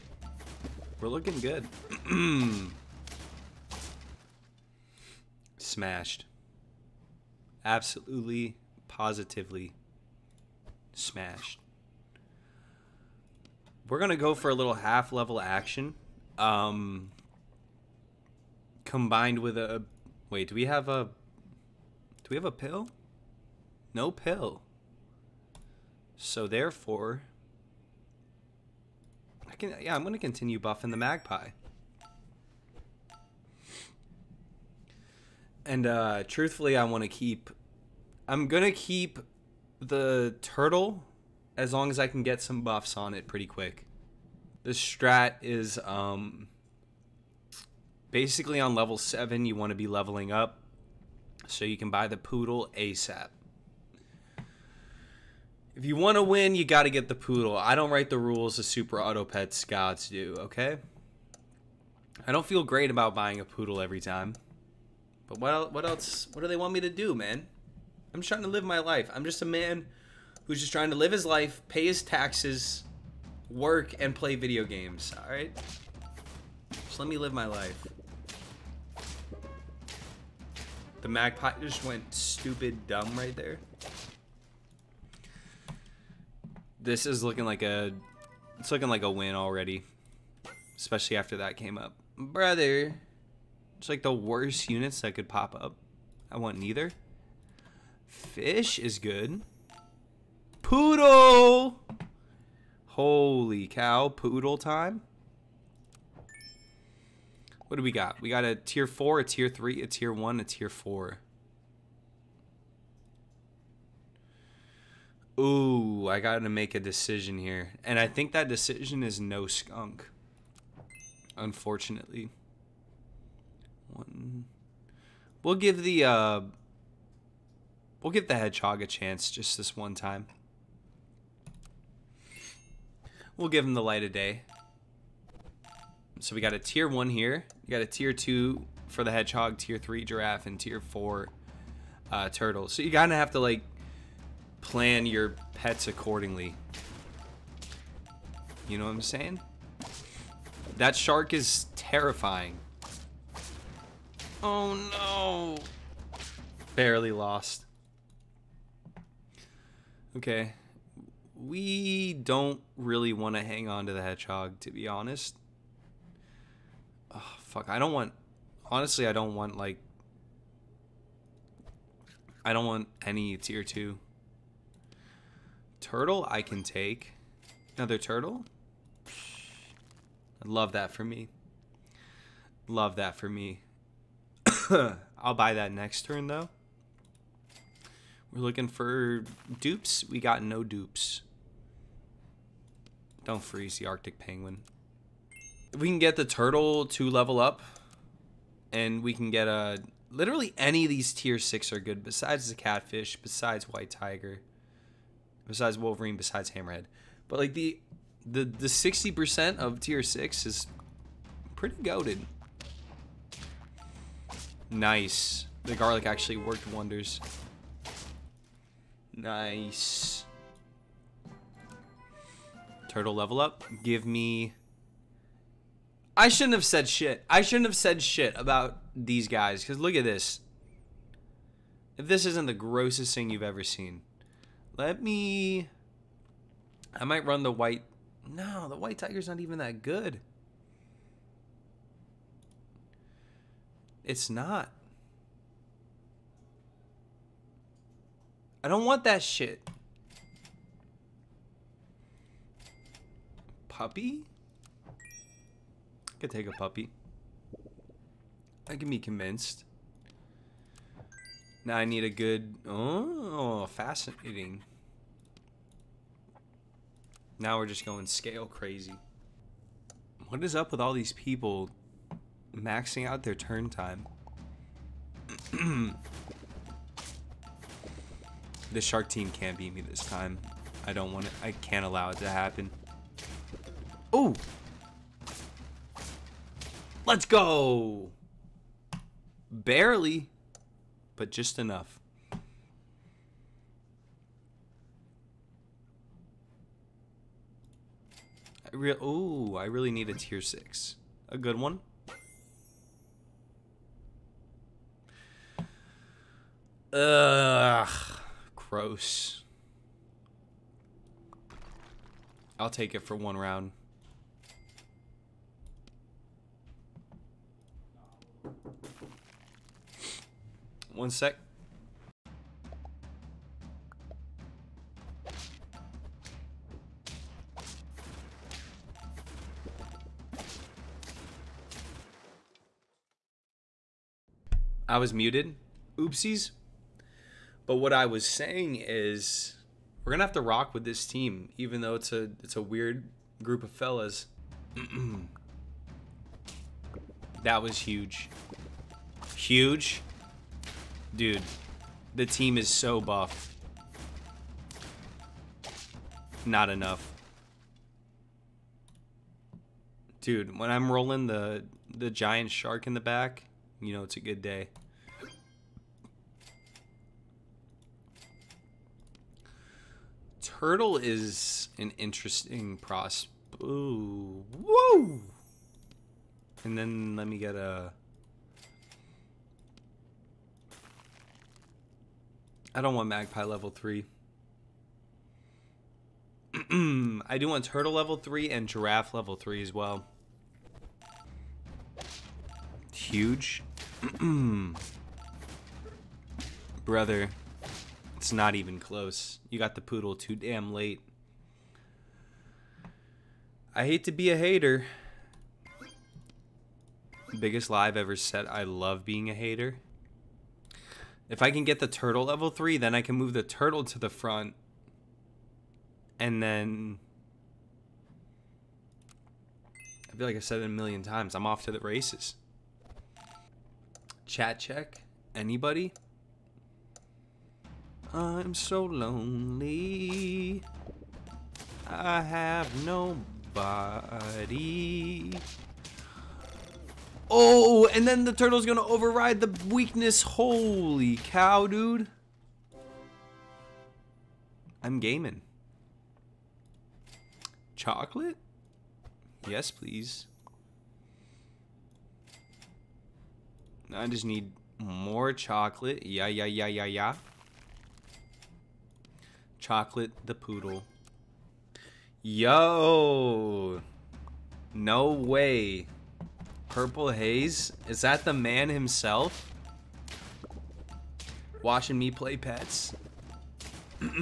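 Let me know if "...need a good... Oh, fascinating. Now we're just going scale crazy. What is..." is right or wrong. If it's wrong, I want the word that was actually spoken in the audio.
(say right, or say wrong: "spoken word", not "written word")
right.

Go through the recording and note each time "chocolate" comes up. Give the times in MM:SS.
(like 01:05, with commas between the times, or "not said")
07:27, 07:35, 07:39.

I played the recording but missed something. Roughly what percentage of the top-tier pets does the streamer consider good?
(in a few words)
60%.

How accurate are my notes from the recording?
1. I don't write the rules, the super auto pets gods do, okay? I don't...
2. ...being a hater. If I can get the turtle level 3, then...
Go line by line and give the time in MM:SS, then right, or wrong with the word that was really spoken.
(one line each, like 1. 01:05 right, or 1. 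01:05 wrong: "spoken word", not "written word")
1. 00:57 right
2. 06:49 right.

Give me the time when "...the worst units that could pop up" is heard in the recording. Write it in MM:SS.
01:34.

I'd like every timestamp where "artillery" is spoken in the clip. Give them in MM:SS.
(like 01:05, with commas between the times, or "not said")
not said.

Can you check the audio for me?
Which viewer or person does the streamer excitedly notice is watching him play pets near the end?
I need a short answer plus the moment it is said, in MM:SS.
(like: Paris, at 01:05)
Purple Haze, at 07:46.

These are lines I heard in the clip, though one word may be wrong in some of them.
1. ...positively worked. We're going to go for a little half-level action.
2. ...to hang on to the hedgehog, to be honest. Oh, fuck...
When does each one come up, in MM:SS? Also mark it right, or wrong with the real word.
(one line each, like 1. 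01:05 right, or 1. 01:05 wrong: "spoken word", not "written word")
1. 00:08 wrong: "smashed", not "worked"
2. 02:43 right.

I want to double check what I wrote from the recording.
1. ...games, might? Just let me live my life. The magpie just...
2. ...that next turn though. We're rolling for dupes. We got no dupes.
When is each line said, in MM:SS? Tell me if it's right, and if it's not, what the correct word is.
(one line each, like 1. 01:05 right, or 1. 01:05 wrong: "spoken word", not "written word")
1. 01:14 wrong: "alright", not "might"
2. 03:05 wrong: "looking", not "rolling".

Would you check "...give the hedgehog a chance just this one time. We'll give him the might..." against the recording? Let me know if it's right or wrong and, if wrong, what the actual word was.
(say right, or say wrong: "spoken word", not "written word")
wrong: "light", not "might".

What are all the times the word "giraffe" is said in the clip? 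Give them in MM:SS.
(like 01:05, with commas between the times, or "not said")
02:20, 06:28.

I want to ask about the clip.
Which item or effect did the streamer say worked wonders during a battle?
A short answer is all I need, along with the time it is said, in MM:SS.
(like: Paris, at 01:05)
Garlic, at 03:35.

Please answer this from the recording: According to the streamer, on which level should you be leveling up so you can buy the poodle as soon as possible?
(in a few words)
7.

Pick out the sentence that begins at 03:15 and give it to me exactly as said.
If we can get the turtle to level up, and we can get a literally any of these tier six are good.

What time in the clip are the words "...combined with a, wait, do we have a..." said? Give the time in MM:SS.
00:18.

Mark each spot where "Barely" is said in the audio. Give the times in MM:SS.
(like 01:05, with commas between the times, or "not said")
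02:36, 04:49.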